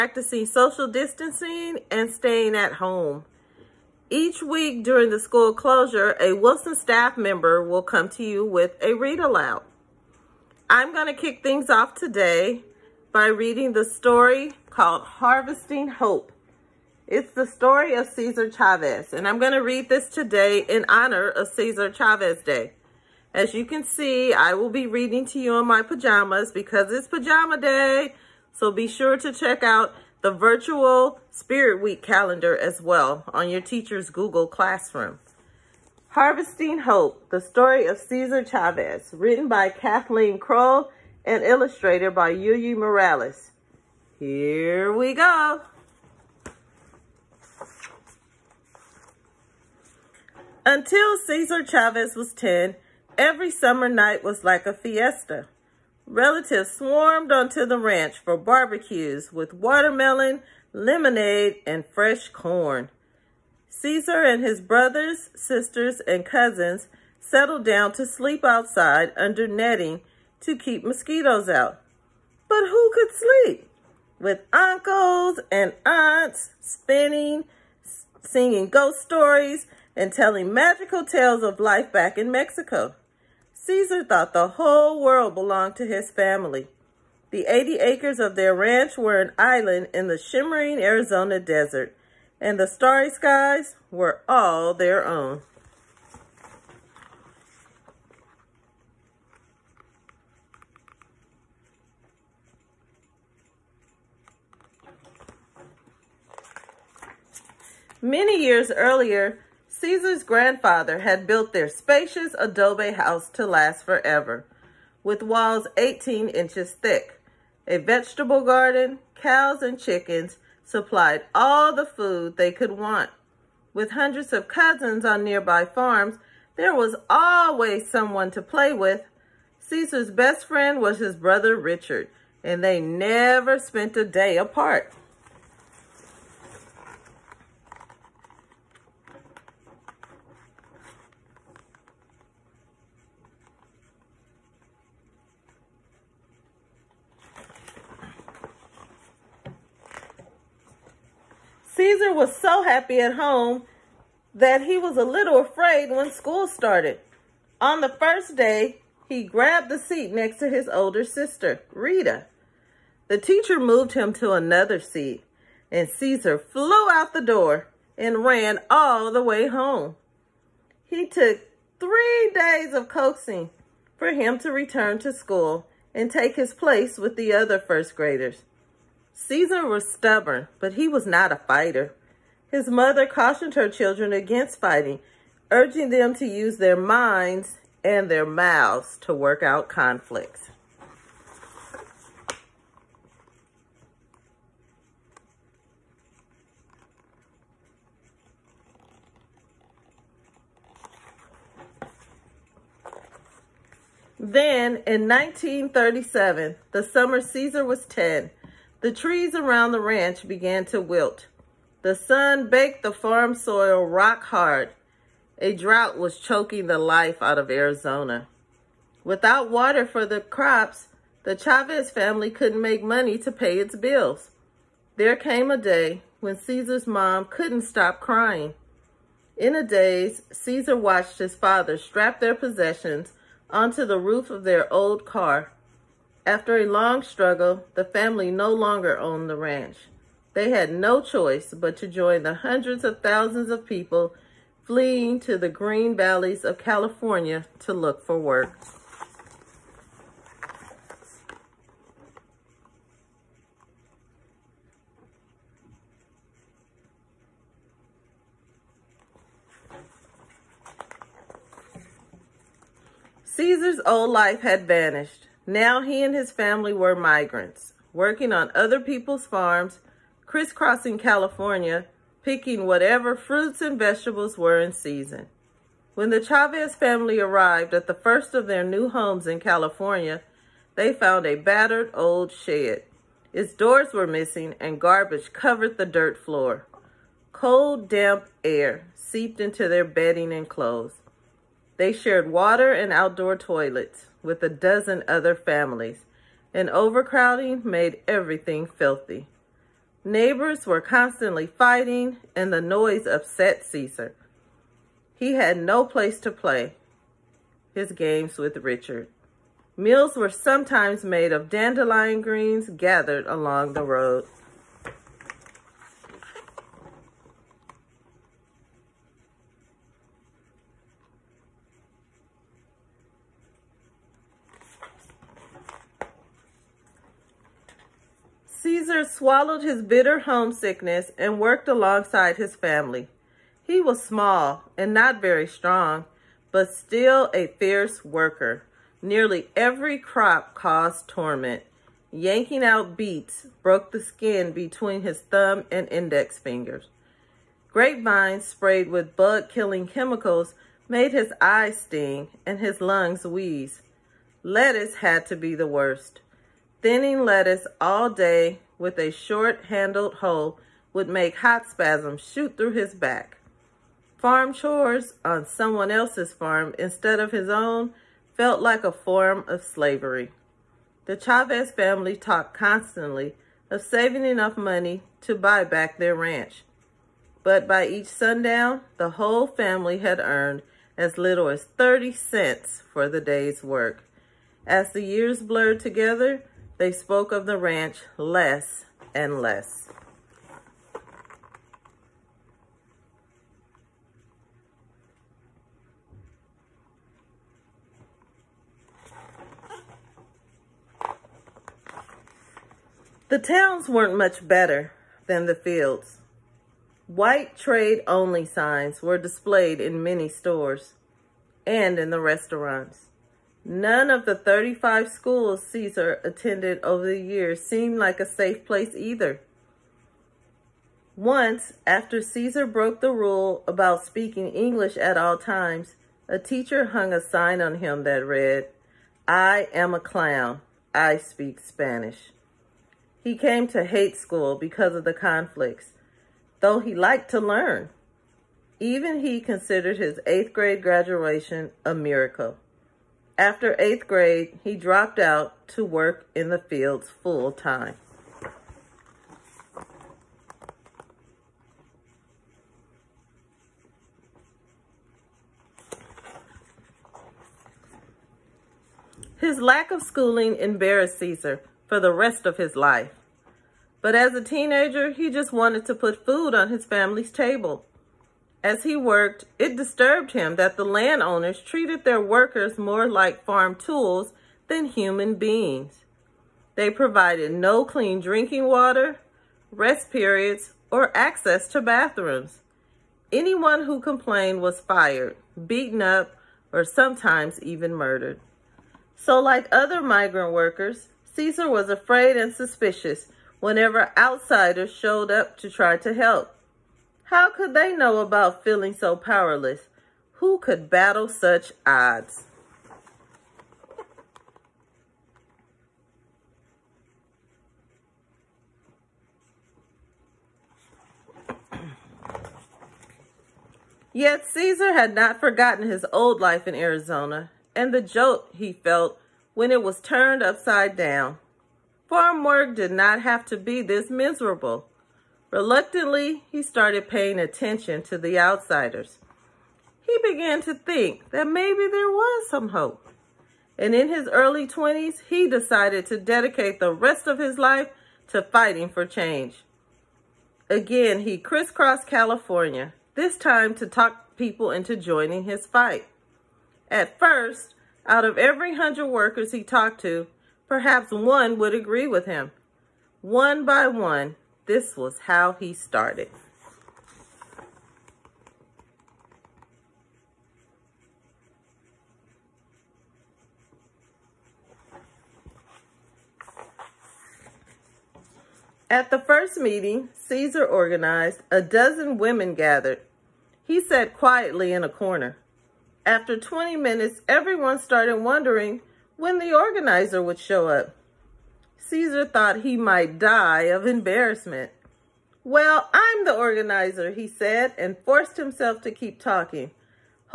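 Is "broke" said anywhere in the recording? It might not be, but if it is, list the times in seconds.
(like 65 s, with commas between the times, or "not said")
343 s, 422 s.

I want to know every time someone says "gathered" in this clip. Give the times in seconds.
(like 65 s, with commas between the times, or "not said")
312 s, 572 s.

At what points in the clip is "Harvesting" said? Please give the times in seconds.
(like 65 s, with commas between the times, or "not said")
15 s, 36 s.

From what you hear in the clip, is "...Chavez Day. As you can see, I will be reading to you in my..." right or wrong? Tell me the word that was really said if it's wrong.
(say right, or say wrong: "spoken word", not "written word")
right.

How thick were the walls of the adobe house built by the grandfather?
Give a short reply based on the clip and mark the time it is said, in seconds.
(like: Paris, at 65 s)
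18 inches, at 115 s.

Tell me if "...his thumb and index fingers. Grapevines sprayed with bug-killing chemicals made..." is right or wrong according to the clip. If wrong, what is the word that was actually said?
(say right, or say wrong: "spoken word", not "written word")
right.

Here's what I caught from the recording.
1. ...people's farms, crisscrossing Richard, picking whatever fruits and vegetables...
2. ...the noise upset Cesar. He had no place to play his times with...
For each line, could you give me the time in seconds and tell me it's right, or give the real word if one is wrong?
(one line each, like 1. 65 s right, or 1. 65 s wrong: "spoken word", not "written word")
1. 268 s wrong: "California", not "Richard"
2. 302 s wrong: "games", not "times".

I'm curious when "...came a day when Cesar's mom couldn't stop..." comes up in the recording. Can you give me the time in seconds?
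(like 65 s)
225 s.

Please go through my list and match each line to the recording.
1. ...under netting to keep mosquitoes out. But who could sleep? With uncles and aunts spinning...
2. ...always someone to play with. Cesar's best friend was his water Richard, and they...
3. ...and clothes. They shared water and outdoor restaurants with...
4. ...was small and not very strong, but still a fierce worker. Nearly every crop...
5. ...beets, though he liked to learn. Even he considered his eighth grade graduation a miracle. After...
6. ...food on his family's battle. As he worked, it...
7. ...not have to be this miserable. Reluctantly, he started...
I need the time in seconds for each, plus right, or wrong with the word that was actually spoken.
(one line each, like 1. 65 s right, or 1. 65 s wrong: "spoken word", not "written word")
1. 69 s right
2. 127 s wrong: "brother", not "water"
3. 290 s wrong: "toilets", not "restaurants"
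4. 333 s right
5. 435 s wrong: "conflicts", not "beets"
6. 466 s wrong: "table", not "battle"
7. 522 s right.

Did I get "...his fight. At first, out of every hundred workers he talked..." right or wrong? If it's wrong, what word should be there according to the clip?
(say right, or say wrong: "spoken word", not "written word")
right.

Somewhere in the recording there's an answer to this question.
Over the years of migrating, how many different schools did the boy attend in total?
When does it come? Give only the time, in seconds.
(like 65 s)
414 s.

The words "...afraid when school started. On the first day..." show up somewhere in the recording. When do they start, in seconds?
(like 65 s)
155 s.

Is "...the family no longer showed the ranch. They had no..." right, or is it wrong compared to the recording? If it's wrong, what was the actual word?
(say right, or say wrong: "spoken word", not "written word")
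wrong: "owned", not "showed".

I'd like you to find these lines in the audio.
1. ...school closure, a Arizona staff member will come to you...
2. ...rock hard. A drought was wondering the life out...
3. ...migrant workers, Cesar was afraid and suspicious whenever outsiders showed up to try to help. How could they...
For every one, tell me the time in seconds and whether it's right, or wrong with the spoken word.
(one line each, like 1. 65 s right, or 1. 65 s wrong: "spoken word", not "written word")
1. 5 s wrong: "Wilson", not "Arizona"
2. 213 s wrong: "choking", not "wondering"
3. 490 s right.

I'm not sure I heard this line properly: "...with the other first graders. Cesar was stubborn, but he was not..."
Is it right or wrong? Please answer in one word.
right.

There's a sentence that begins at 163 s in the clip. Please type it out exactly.
The teacher moved him to another seat, and Cesar flew out the door and ran all the way home.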